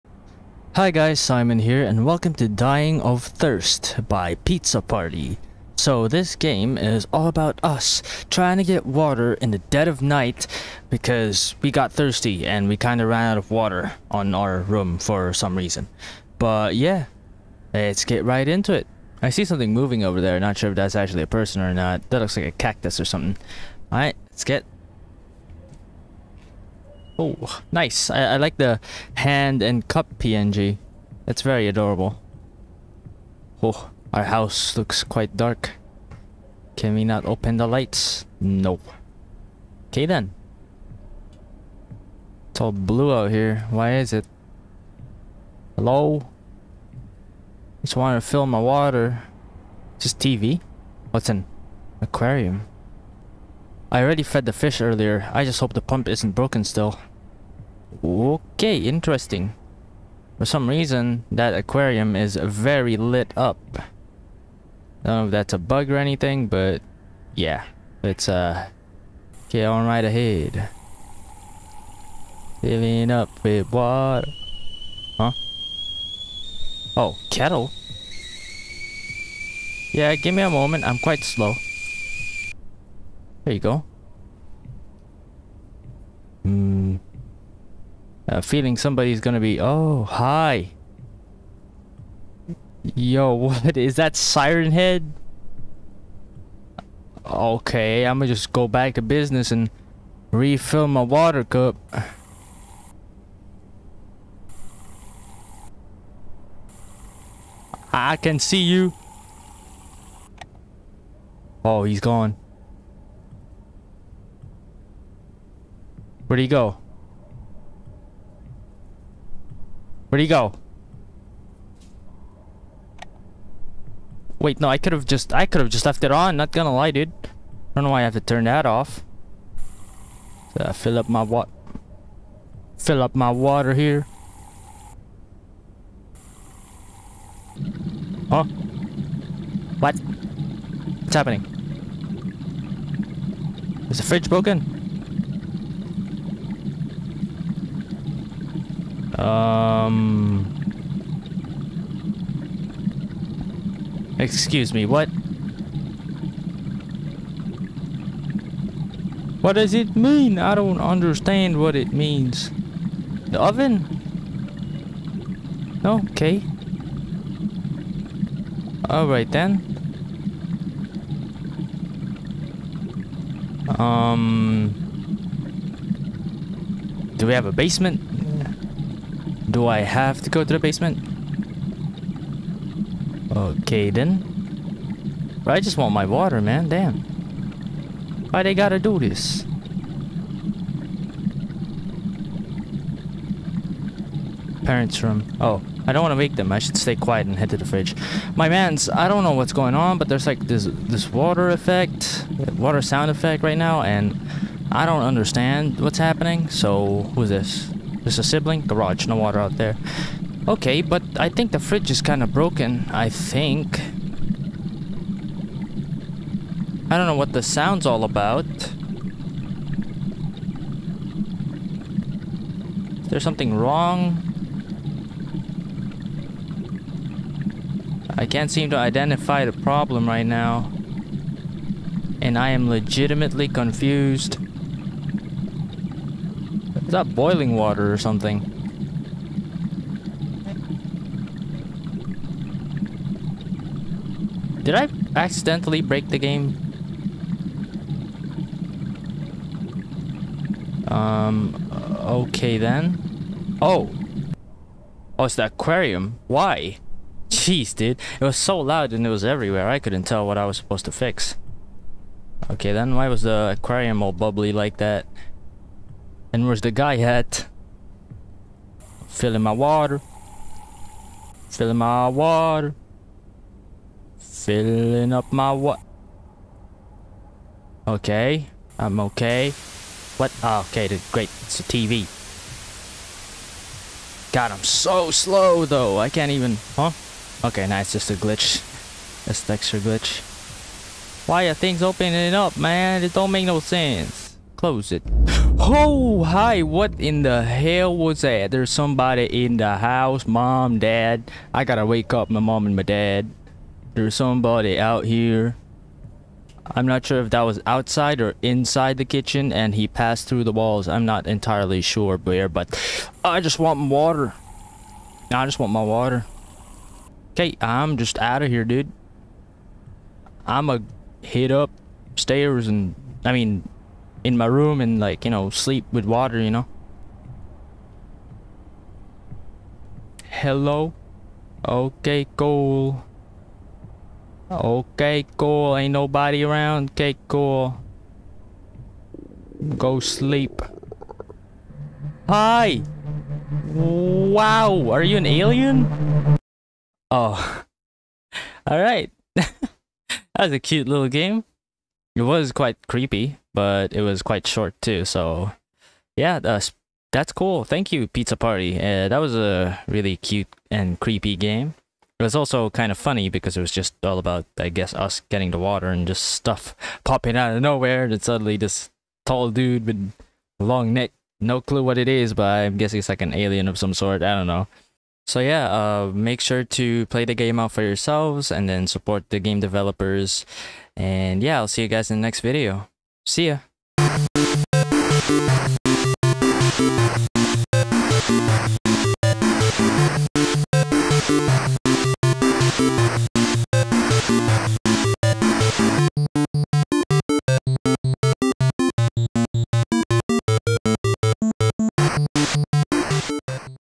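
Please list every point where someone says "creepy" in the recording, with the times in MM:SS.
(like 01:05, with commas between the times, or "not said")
05:52, 06:00.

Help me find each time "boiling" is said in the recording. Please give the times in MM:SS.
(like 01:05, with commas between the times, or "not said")
03:57.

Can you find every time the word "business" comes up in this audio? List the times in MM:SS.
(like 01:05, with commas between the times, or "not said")
01:39.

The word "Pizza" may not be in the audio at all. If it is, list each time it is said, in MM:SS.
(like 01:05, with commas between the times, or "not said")
00:04, 05:58.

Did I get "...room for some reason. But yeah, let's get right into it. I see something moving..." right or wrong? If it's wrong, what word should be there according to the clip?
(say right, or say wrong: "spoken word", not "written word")
right.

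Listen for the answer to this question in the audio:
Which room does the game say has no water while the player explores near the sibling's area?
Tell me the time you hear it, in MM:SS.
03:28.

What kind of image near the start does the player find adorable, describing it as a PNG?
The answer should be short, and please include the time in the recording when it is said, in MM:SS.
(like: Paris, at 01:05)
hand and cup, at 00:29.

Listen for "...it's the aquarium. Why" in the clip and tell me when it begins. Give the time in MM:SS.
04:15.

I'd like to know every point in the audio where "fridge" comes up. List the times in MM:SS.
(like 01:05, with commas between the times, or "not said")
02:24, 03:17, 03:31.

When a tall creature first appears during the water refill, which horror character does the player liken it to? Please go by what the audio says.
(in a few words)
Siren Head.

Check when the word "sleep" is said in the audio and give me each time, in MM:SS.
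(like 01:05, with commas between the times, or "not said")
05:25, 05:39.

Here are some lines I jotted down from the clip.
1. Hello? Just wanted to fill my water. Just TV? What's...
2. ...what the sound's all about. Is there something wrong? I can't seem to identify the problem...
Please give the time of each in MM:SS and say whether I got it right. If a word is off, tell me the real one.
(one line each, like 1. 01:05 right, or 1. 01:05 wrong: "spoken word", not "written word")
1. 00:45 right
2. 03:37 right.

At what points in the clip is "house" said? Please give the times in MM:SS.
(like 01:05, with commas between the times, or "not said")
00:34, 04:59.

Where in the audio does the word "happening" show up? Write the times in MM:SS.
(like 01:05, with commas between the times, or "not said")
02:21, 03:25.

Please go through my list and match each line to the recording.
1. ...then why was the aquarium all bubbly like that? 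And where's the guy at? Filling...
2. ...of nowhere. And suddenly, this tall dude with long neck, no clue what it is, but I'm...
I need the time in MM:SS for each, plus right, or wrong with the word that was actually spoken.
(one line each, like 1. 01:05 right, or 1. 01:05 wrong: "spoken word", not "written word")
1. 04:22 right
2. 06:07 right.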